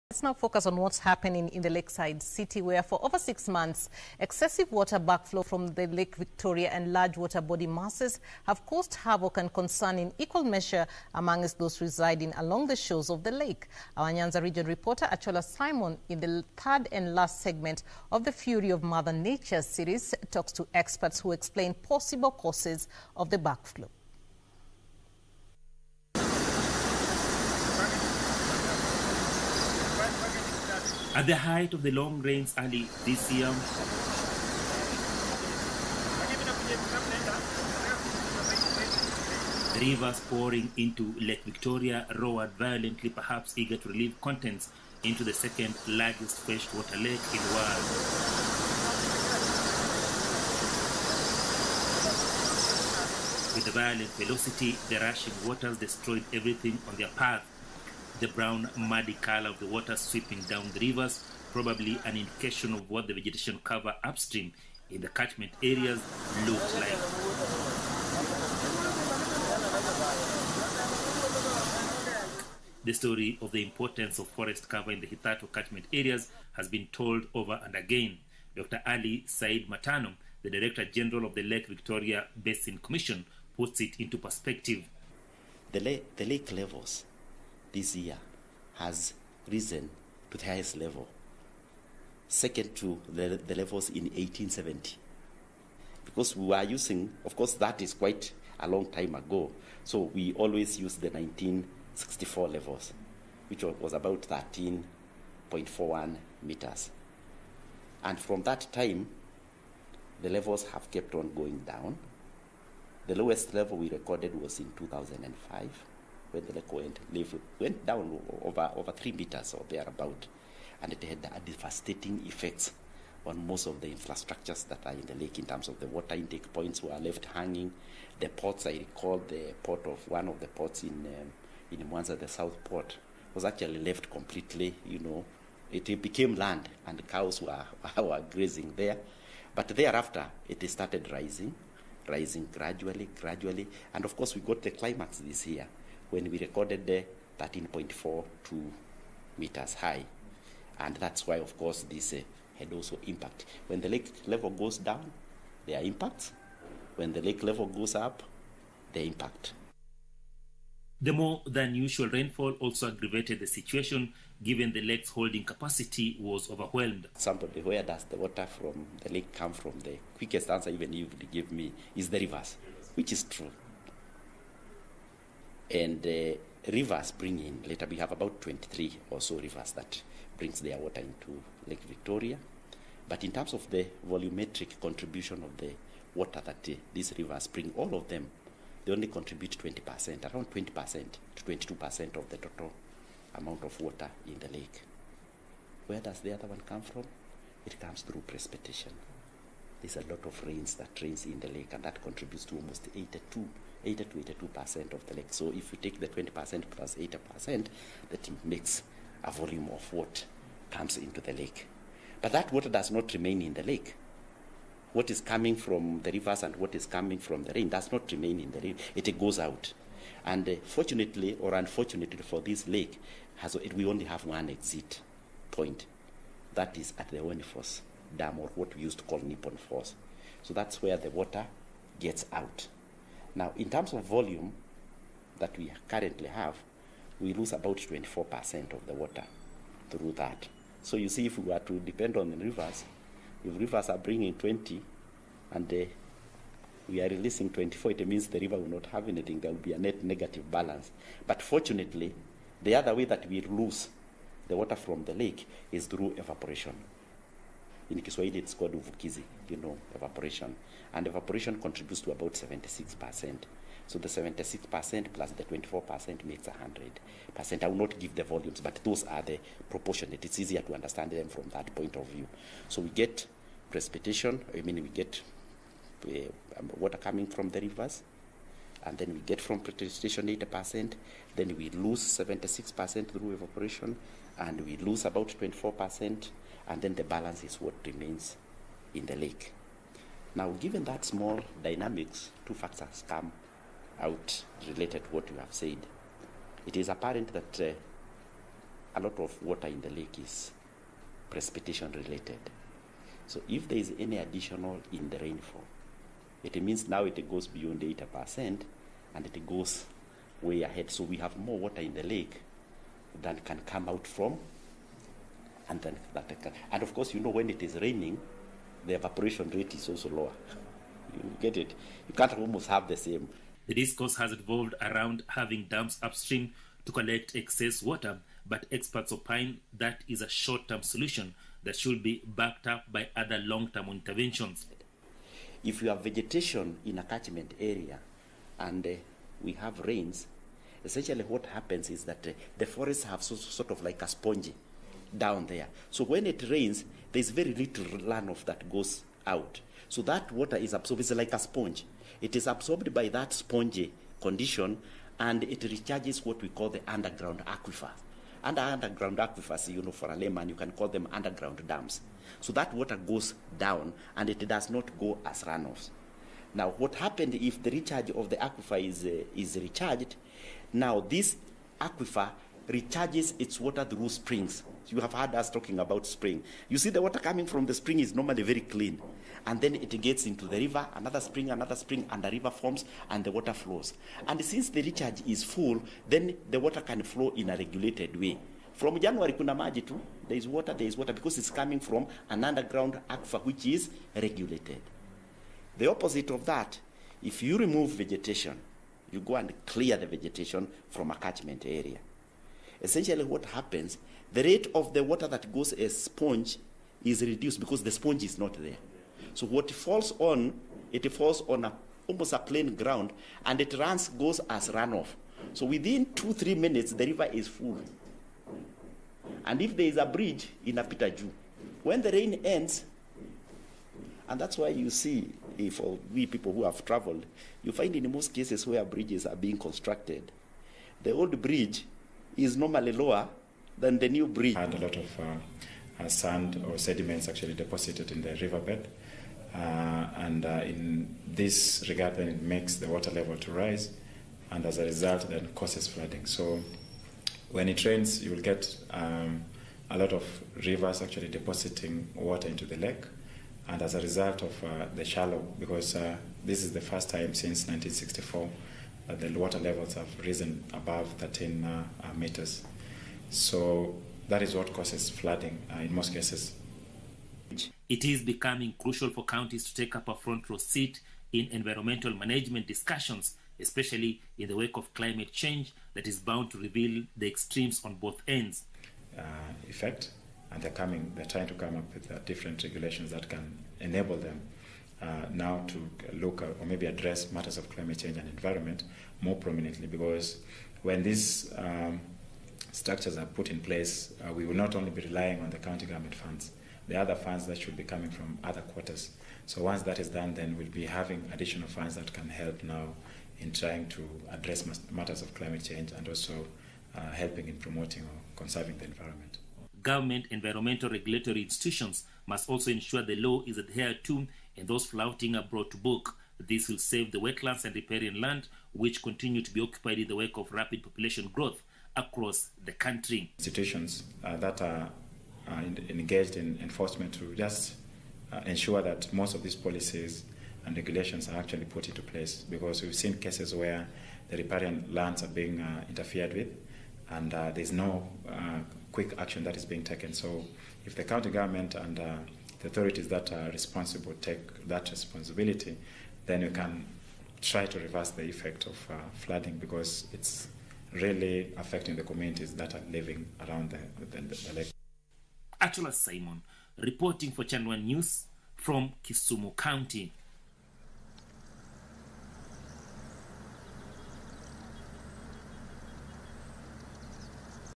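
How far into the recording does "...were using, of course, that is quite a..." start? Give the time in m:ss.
1:36.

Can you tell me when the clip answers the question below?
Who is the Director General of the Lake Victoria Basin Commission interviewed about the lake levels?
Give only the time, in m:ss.
1:18.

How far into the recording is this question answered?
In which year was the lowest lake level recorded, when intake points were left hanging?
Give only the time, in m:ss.
1:54.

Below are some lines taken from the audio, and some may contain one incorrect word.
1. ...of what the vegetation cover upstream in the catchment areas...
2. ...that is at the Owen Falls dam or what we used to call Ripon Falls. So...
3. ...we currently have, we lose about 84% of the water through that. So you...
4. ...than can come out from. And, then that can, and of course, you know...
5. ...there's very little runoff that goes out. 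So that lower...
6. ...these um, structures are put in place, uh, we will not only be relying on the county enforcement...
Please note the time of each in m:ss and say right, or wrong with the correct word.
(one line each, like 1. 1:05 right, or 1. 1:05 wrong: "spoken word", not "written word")
1. 1:02 right
2. 3:46 right
3. 3:55 wrong: "24", not "84"
4. 5:13 right
5. 5:47 wrong: "water", not "lower"
6. 8:11 wrong: "government", not "enforcement".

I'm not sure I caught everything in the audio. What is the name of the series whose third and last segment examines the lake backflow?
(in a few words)
Fury of Mother Nature.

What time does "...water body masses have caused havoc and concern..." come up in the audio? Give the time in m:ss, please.
0:07.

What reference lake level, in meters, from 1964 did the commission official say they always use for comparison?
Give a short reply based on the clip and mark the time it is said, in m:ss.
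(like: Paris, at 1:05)
13.41 meters, at 1:44.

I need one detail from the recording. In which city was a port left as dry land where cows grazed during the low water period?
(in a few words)
Mwanza.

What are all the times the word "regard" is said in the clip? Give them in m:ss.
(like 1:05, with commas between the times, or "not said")
7:21.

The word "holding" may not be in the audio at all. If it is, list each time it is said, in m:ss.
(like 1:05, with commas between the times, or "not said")
2:45.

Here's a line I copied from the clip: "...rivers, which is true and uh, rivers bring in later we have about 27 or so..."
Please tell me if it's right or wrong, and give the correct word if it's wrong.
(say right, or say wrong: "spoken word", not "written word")
wrong: "23", not "27".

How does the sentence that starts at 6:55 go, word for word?
So within two, three minutes, the river is full.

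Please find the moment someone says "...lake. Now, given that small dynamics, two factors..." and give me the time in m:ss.
4:49.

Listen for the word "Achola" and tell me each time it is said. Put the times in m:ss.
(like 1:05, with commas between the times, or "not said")
0:15, 9:15.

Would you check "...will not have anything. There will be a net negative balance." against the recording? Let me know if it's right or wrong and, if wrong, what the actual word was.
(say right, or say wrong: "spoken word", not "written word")
right.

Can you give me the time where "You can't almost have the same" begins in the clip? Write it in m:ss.
5:22.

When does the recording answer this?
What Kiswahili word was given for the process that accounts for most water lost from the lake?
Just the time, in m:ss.
4:18.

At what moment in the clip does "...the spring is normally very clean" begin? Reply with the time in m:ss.
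6:17.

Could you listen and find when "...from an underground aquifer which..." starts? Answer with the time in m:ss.
6:31.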